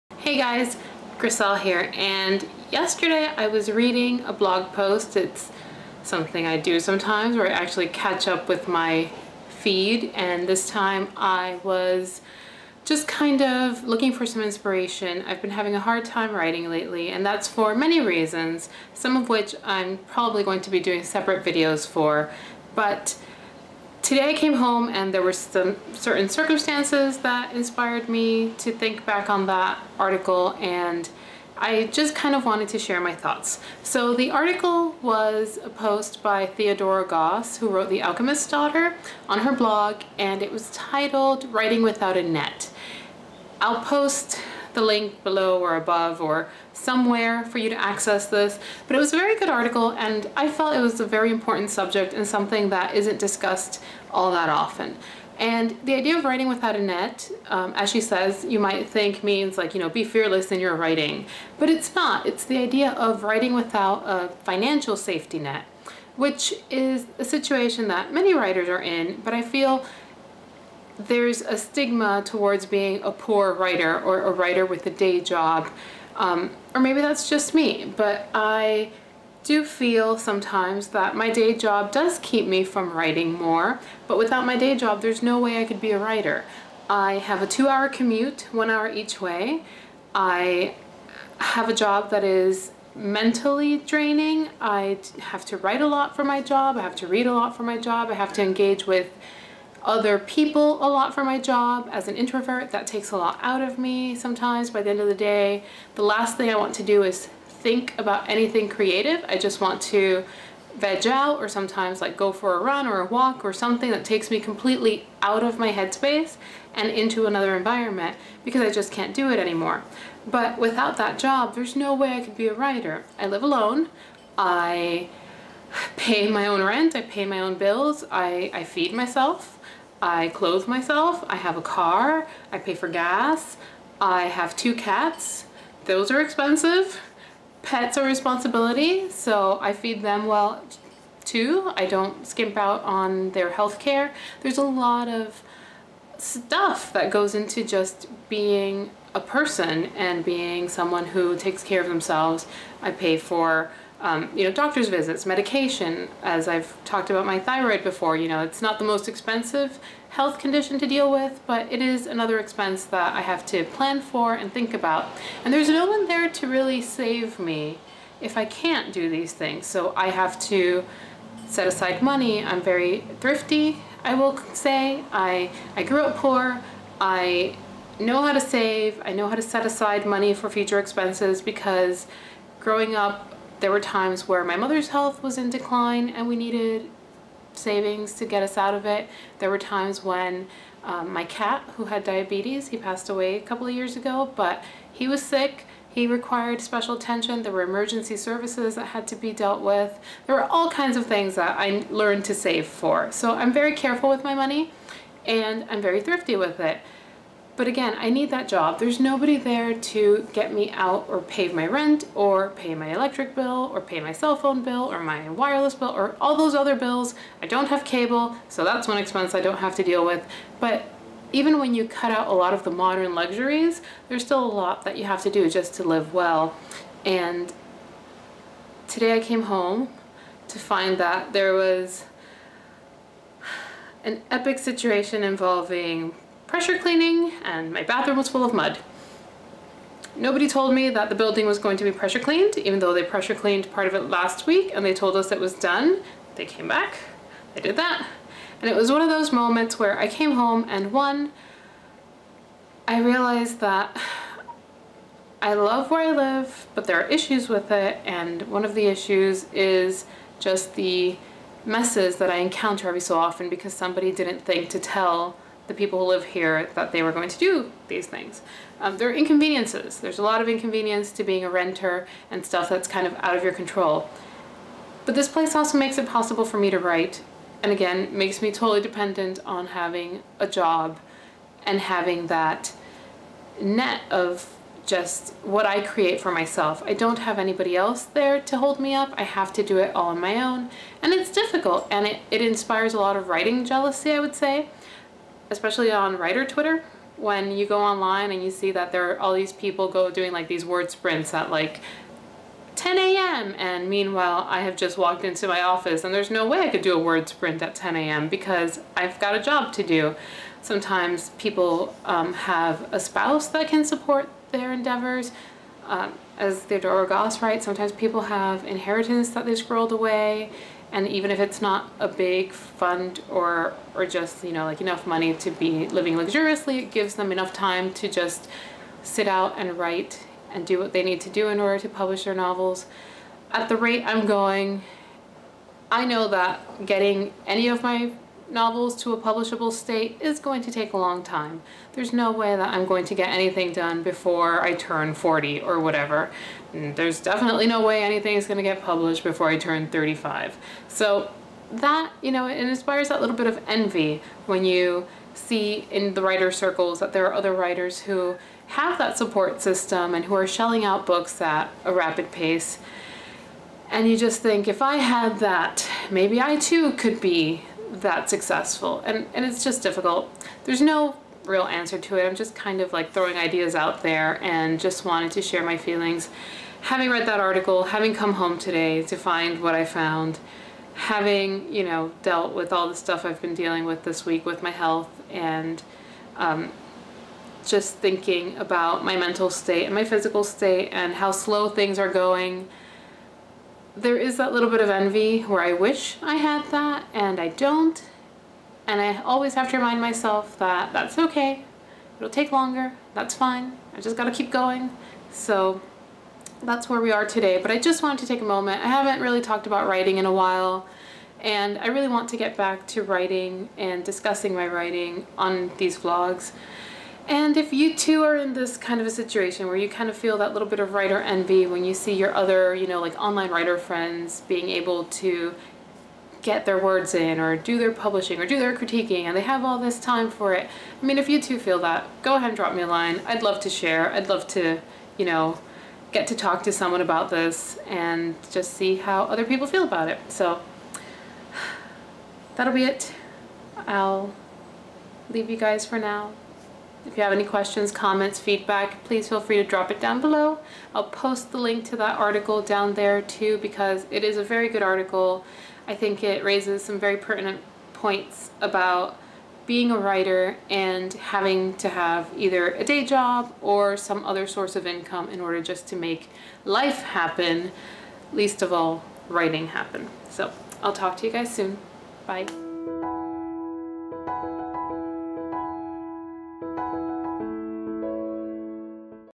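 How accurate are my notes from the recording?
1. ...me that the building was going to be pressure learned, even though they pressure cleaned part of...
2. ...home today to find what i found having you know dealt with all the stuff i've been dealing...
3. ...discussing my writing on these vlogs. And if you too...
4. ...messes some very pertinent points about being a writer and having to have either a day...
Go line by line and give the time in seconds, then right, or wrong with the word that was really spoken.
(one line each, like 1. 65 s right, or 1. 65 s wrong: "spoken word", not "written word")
1. 240 s wrong: "cleaned", not "learned"
2. 378 s right
3. 414 s right
4. 456 s wrong: "raises", not "messes".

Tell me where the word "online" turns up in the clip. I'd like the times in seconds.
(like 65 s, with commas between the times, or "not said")
297 s, 423 s.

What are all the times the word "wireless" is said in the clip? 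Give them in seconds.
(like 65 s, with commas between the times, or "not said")
215 s.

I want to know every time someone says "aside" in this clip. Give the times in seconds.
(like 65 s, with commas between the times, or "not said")
171 s, 179 s.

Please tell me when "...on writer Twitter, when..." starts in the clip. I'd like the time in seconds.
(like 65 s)
295 s.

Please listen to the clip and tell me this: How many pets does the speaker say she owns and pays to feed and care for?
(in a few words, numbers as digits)
2 cats.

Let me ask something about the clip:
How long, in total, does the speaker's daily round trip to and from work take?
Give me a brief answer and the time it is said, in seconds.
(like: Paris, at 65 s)
2 hours, at 87 s.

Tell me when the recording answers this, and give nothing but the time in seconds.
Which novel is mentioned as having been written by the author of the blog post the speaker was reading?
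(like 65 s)
37 s.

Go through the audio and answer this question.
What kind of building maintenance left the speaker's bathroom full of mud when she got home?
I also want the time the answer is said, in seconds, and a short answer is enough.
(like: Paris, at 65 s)
Pressure cleaning, at 236 s.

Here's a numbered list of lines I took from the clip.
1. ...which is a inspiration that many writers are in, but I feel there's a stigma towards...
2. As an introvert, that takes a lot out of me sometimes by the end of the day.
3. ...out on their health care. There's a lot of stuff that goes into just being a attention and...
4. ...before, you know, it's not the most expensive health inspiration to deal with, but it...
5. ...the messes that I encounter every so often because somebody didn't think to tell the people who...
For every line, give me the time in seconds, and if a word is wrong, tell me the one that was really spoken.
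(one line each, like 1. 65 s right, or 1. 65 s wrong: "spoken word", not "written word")
1. 66 s wrong: "situation", not "inspiration"
2. 101 s right
3. 142 s wrong: "person", not "attention"
4. 157 s wrong: "condition", not "inspiration"
5. 260 s right.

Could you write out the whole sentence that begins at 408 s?
I haven't really talked about writing in a while.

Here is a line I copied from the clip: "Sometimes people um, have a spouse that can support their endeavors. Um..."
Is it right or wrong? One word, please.
right.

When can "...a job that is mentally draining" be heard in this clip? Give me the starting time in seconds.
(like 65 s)
91 s.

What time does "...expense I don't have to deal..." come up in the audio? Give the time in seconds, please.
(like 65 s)
218 s.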